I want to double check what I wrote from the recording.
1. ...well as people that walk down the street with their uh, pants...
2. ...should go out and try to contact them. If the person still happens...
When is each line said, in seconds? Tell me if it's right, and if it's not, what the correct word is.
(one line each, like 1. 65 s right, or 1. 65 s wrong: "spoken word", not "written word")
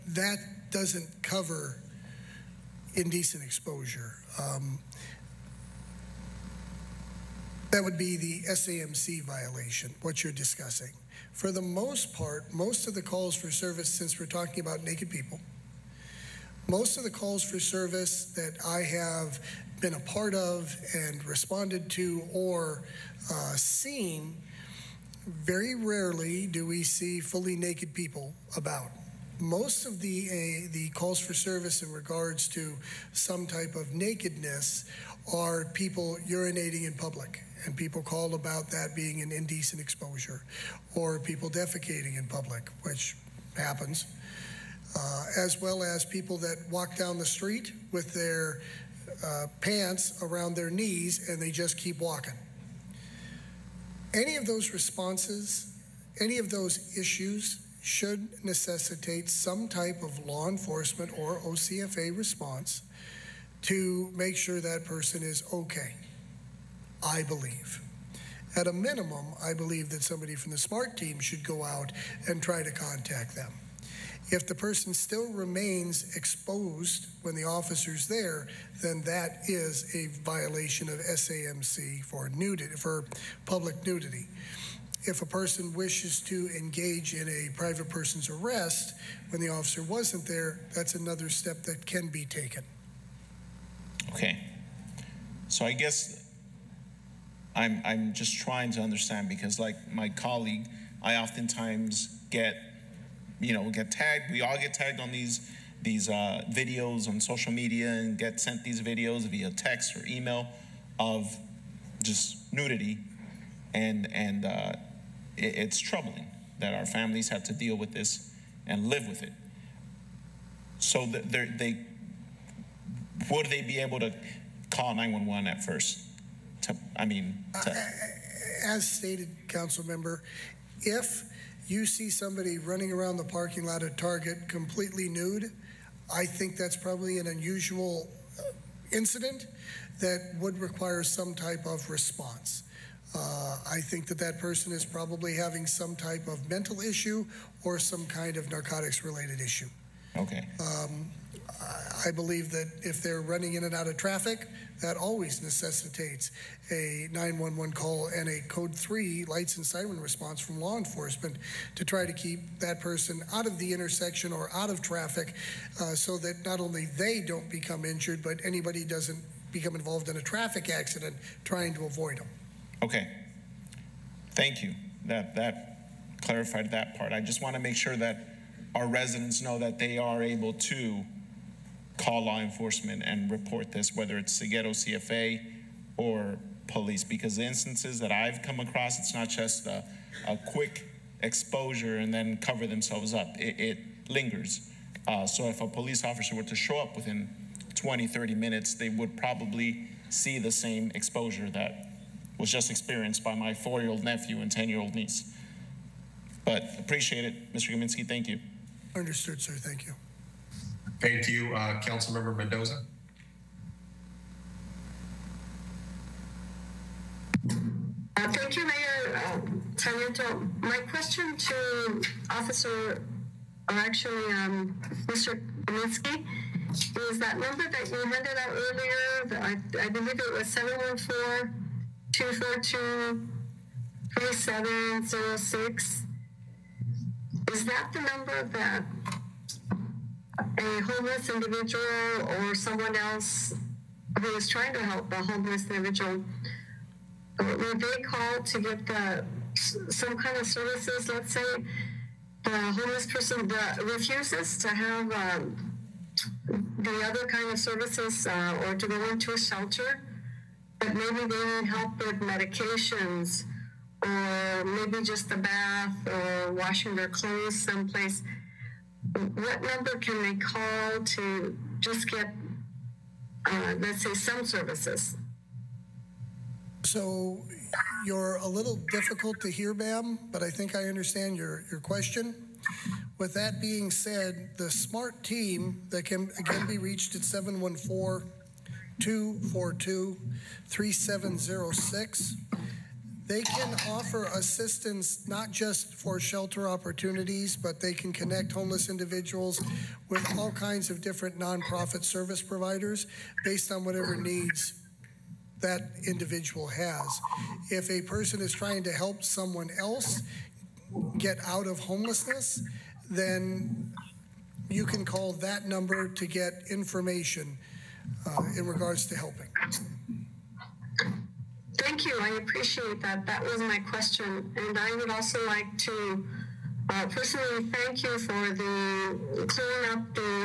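1. 45 s right
2. 71 s wrong: "remains", not "happens".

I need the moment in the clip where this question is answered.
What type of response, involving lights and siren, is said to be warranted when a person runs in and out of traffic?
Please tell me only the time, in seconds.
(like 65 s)
158 s.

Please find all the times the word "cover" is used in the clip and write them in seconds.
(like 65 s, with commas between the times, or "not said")
1 s, 192 s.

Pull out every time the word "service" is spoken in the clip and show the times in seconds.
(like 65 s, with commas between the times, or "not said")
13 s, 17 s, 31 s, 250 s, 257 s, 274 s, 302 s.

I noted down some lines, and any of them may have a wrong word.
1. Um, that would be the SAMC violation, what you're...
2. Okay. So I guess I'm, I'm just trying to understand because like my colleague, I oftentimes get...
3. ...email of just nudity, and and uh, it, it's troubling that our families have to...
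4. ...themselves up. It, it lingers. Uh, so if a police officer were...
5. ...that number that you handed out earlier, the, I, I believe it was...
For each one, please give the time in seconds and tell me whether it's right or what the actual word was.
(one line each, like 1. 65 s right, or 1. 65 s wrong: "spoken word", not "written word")
1. 4 s right
2. 94 s right
3. 110 s right
4. 192 s right
5. 227 s right.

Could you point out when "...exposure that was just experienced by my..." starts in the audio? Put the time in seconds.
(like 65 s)
200 s.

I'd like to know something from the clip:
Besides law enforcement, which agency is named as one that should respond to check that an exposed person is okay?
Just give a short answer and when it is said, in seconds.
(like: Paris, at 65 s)
OCFA, at 61 s.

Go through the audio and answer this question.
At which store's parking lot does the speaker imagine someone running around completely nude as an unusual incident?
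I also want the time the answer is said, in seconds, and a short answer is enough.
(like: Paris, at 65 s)
Target, at 133 s.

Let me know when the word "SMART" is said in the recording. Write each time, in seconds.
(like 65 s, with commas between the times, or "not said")
70 s, 284 s.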